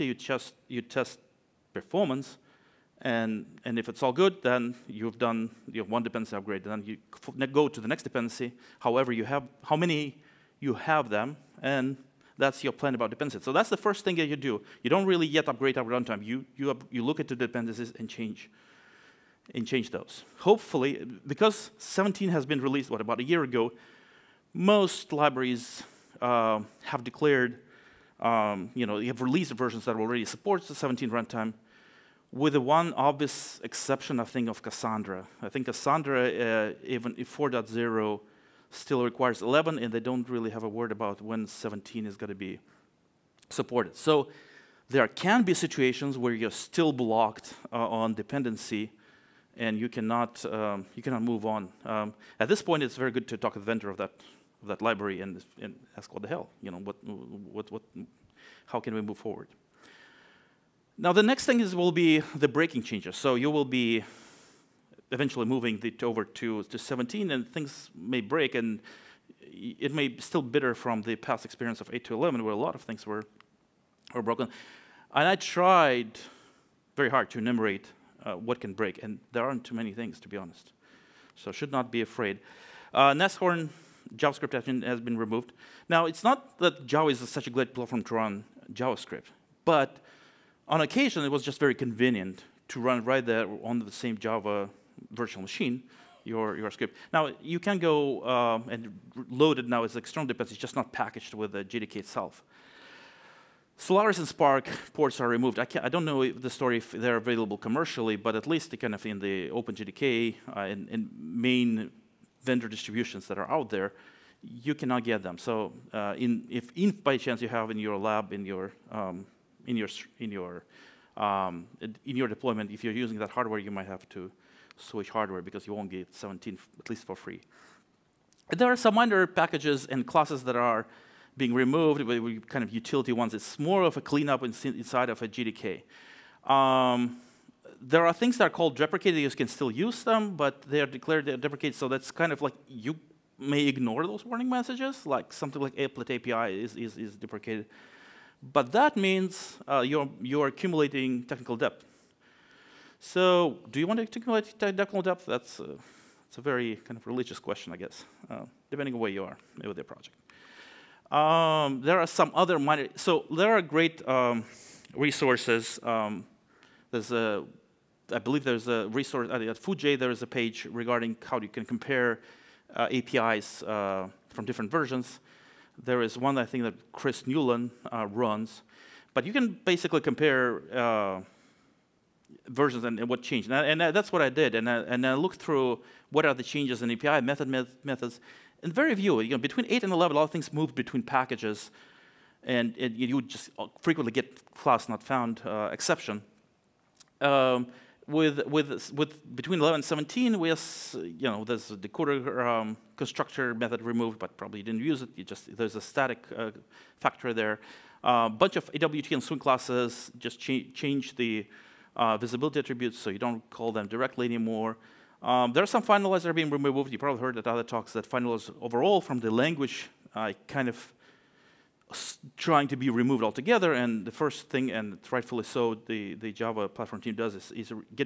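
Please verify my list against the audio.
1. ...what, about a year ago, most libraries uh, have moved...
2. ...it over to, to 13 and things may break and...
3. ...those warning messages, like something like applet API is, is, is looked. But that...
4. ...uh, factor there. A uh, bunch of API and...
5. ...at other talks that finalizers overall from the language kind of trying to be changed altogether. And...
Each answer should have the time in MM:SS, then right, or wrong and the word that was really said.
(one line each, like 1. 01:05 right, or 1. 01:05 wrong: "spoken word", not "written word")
1. 00:22 wrong: "declared", not "moved"
2. 01:05 wrong: "17", not "13"
3. 02:24 wrong: "deprecated", not "looked"
4. 03:26 wrong: "AWT", not "API"
5. 03:37 wrong: "removed", not "changed".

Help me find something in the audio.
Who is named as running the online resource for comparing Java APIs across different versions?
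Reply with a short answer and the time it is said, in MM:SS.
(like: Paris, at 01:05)
Chris Newland, at 02:56.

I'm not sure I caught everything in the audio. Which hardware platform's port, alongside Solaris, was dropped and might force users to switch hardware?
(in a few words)
SPARC.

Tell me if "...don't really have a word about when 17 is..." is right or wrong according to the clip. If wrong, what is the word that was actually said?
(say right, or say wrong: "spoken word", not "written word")
right.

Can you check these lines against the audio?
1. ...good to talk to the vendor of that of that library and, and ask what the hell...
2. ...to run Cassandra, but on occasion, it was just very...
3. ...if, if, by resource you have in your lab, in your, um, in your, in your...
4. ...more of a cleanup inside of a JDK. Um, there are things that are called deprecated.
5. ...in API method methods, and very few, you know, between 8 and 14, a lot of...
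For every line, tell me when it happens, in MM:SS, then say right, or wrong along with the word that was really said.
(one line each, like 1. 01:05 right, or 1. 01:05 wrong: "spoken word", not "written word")
1. 00:53 right
2. 01:28 wrong: "JavaScript", not "Cassandra"
3. 01:56 wrong: "chance", not "resource"
4. 02:13 right
5. 03:06 wrong: "11", not "14".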